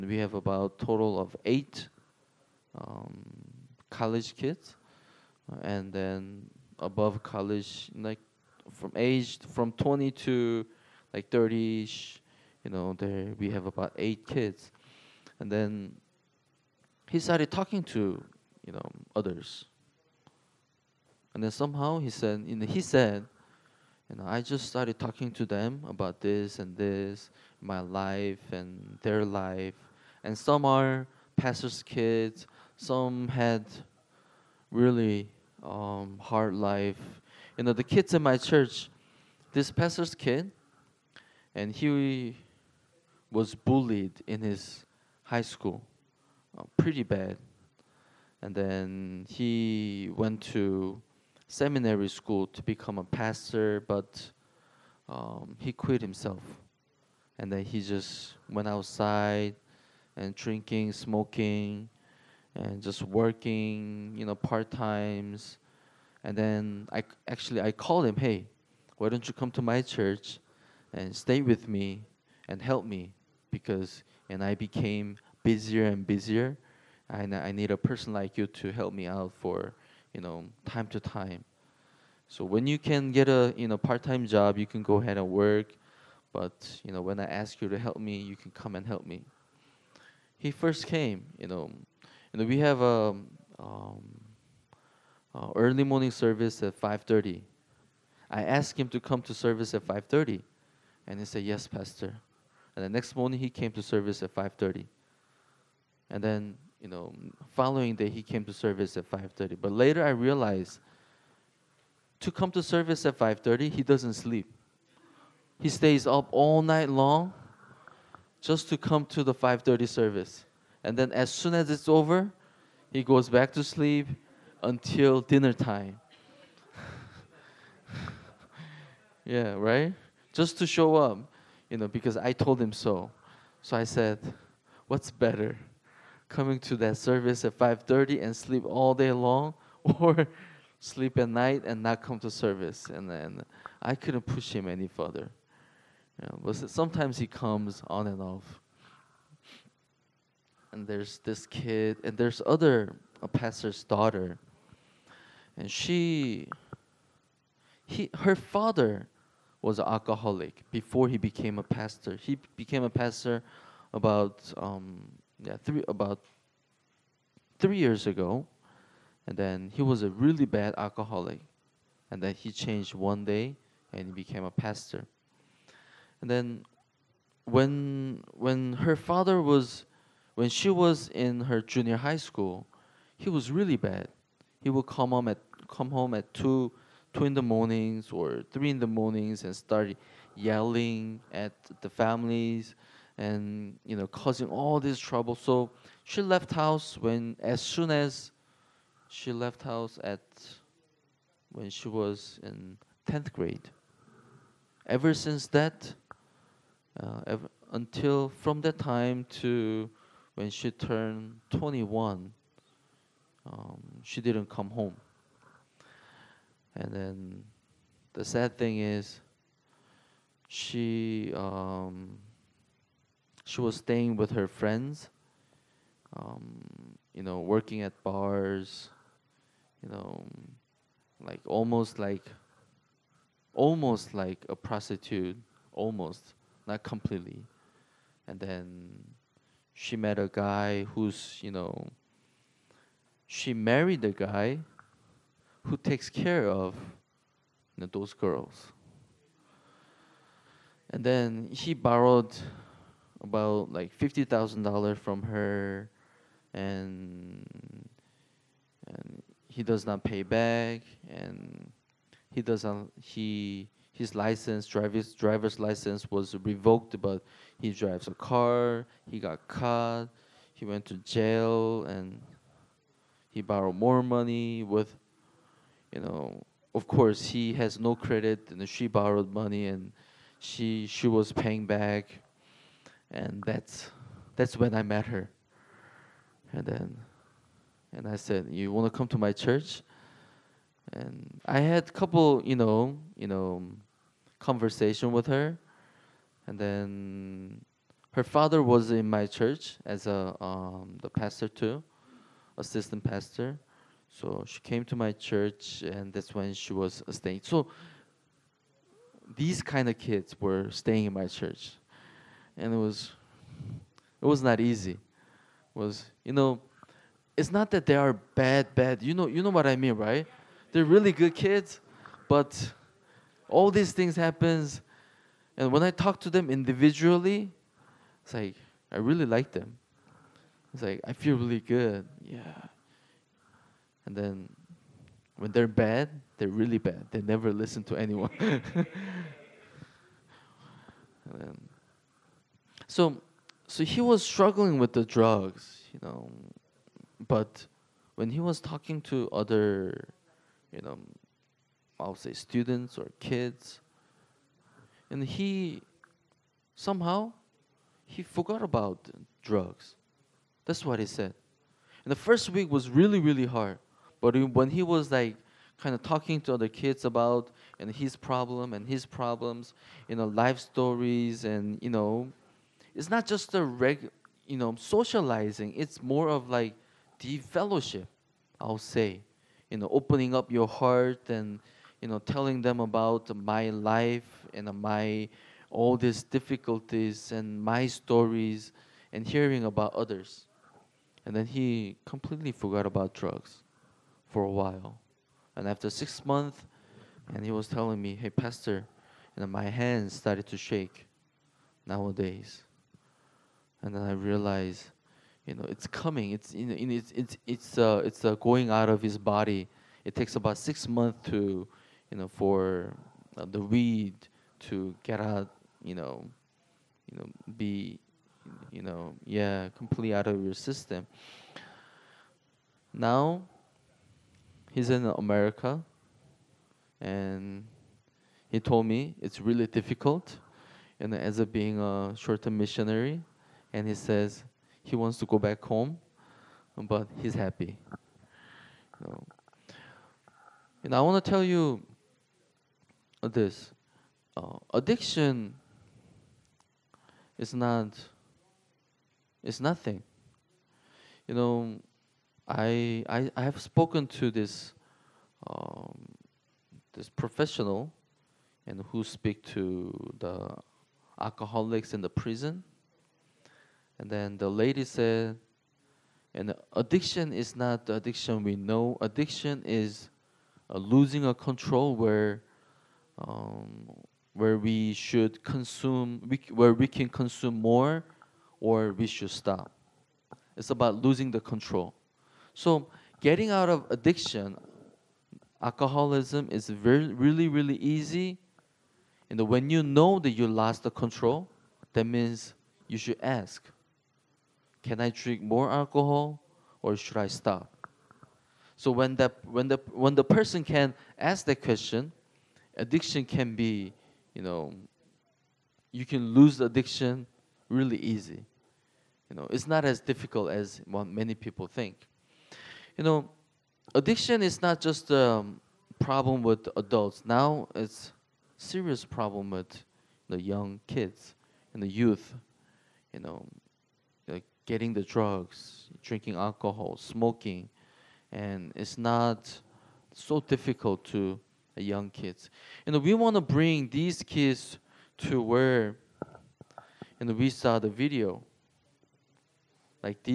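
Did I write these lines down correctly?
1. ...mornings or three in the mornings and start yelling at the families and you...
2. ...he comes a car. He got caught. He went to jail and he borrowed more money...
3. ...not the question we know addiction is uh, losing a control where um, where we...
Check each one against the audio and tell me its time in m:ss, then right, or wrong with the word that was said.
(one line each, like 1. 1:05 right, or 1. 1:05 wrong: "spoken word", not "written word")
1. 3:07 right
2. 4:27 wrong: "drives", not "comes"
3. 7:47 wrong: "addiction", not "question".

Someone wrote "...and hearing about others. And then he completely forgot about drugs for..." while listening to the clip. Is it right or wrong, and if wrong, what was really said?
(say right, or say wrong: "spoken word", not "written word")
right.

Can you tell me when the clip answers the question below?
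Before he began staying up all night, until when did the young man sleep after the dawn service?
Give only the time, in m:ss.
2:05.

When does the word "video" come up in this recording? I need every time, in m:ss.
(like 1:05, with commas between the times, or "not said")
8:57.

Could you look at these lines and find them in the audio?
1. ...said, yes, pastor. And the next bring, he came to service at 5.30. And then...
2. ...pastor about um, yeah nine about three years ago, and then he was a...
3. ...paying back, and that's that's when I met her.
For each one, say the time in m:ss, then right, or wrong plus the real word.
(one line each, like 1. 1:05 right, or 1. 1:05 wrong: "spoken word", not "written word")
1. 1:41 wrong: "morning", not "bring"
2. 2:42 wrong: "three", not "nine"
3. 4:41 right.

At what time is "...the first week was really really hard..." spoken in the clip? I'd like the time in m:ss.
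6:02.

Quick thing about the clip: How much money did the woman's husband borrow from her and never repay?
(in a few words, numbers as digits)
$50,000.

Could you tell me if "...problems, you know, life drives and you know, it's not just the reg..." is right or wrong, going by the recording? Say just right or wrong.
wrong.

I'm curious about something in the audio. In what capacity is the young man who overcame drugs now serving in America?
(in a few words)
short-term missionary.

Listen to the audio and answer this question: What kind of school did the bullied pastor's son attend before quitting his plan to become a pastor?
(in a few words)
seminary school.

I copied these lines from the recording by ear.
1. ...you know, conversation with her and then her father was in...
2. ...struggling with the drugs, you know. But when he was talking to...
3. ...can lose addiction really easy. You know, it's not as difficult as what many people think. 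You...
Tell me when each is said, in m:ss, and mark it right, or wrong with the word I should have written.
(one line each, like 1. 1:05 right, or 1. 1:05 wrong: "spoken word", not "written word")
1. 4:53 right
2. 5:44 right
3. 8:26 right.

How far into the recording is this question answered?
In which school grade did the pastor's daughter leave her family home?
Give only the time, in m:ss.
3:23.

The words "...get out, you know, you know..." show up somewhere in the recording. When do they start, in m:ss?
6:55.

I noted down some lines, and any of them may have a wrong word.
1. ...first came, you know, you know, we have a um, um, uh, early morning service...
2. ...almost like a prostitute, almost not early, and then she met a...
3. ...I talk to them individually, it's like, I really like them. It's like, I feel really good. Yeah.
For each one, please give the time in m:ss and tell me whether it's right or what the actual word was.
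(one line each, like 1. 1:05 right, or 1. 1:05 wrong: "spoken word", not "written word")
1. 1:30 right
2. 3:53 wrong: "completely", not "early"
3. 5:25 right.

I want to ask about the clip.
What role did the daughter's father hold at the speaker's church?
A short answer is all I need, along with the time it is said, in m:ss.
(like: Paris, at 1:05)
assistant pastor, at 5:02.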